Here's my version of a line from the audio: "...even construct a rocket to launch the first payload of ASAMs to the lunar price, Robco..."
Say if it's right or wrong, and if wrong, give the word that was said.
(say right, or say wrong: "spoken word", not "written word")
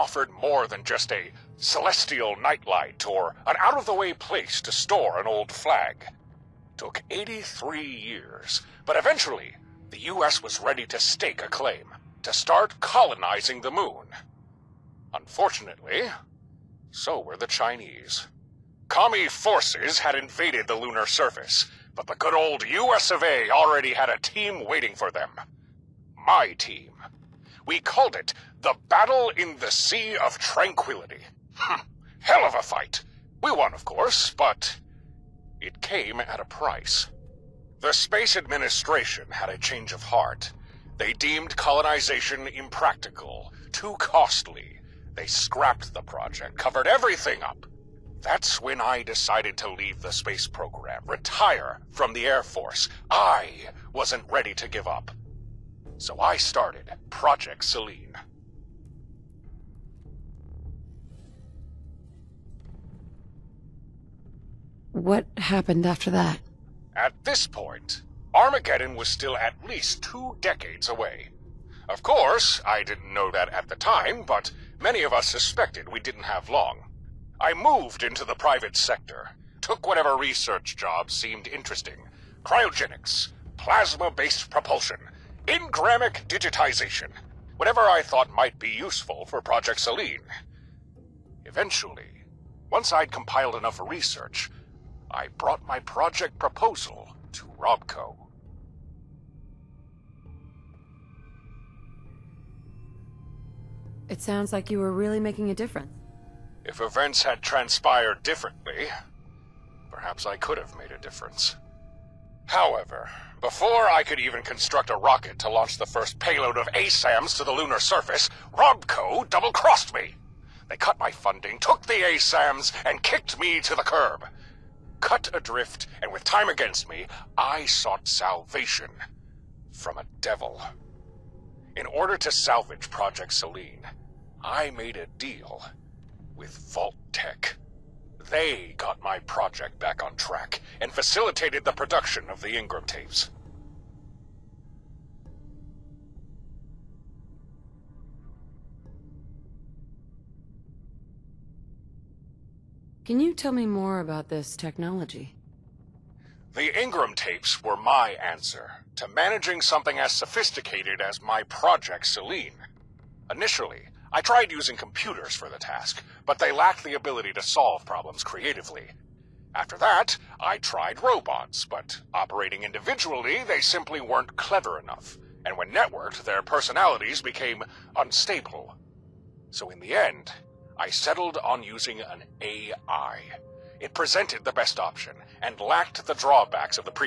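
wrong: "surface", not "price".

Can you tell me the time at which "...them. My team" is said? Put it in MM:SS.
00:25.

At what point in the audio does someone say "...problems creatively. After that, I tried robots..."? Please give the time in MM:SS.
02:47.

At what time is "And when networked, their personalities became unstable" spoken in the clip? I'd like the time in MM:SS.
02:55.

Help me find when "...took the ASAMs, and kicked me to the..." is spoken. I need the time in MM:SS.
02:01.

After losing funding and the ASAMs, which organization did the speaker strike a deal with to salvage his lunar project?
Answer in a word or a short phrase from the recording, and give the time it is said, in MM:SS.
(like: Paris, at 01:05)
Vault Tech, at 02:16.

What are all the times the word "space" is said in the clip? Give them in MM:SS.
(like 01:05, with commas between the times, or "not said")
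00:37, 00:50.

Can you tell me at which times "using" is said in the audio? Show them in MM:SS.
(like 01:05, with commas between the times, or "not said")
02:44, 03:01.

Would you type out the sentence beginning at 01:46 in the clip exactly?
If events had transpired differently, perhaps I could have made a difference.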